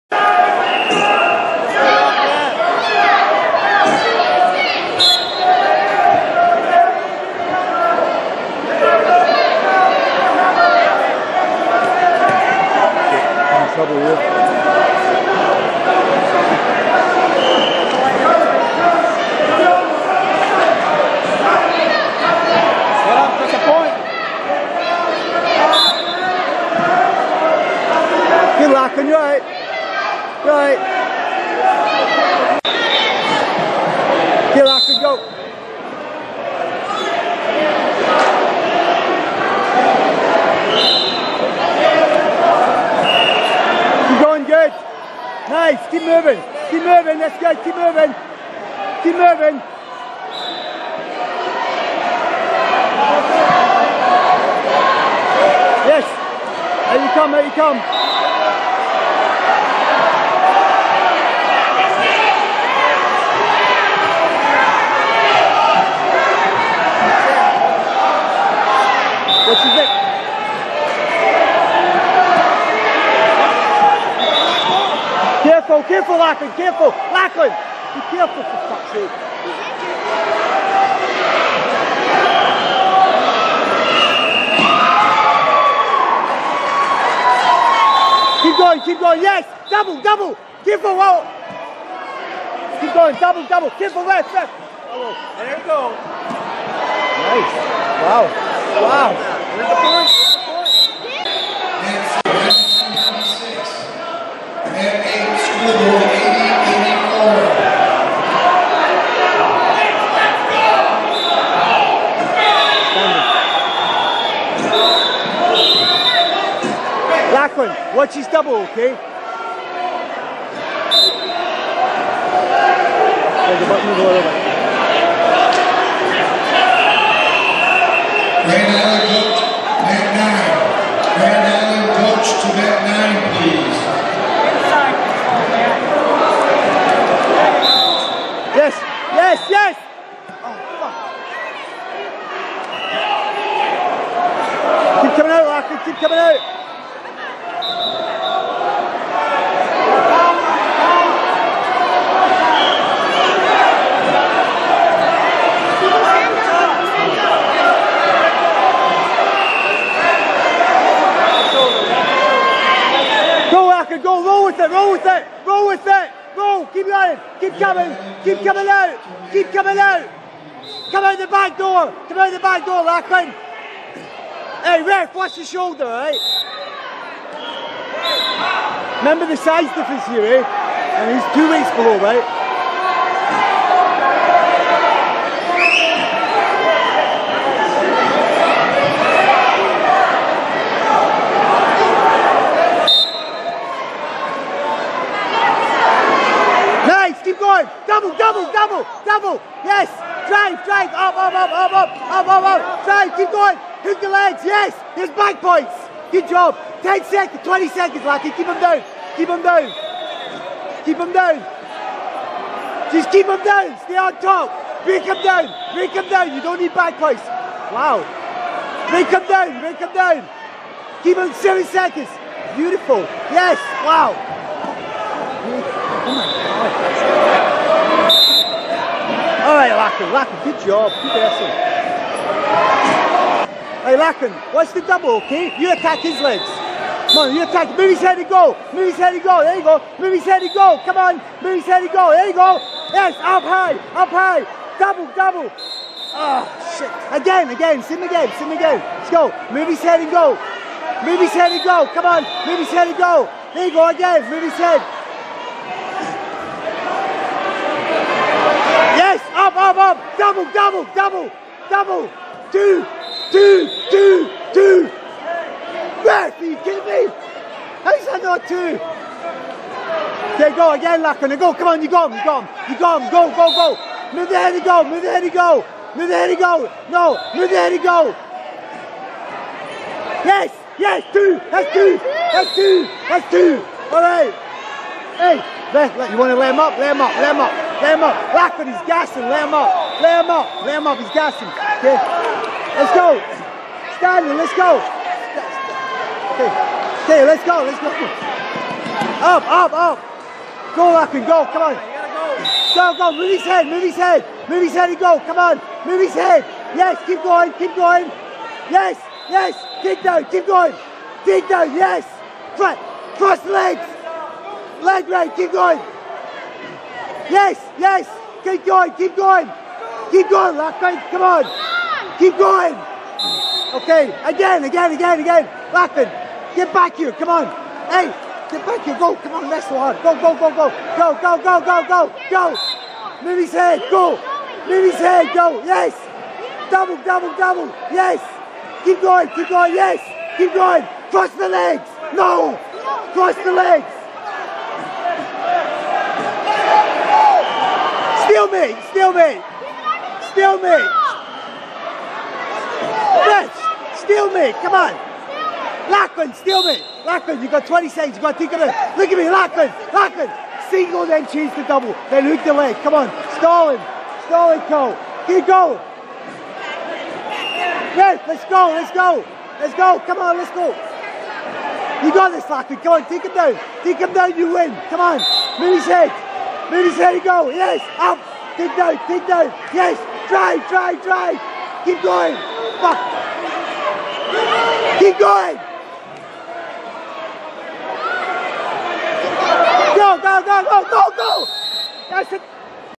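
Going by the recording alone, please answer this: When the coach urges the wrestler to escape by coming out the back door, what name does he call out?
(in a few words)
Larkin.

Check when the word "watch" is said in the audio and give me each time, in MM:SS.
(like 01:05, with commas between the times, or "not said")
02:55, 03:54.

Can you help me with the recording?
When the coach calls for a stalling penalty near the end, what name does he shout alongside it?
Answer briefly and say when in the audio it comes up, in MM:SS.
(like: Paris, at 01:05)
Cole, at 06:04.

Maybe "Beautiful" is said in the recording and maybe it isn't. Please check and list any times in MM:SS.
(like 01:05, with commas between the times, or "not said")
03:42.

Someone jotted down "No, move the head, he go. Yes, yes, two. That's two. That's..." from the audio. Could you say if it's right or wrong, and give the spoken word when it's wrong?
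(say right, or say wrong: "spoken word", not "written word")
right.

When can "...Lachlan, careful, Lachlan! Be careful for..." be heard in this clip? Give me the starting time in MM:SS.
01:16.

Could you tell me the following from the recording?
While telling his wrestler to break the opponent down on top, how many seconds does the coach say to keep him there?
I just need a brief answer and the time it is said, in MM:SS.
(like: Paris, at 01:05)
7, at 03:41.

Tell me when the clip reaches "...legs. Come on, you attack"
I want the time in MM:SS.
03:56.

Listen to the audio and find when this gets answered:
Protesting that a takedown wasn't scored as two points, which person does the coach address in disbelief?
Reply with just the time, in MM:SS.
04:26.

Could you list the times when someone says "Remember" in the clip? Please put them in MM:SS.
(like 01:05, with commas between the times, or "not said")
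02:59.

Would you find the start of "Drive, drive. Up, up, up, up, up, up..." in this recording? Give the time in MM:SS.
03:20.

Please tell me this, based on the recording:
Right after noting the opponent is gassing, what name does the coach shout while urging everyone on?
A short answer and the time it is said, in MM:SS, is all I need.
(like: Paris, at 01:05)
Stanley, at 04:53.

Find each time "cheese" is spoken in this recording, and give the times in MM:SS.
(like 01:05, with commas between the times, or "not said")
06:01.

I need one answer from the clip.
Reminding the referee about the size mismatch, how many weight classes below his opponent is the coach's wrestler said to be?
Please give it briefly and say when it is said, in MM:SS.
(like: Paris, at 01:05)
2, at 03:01.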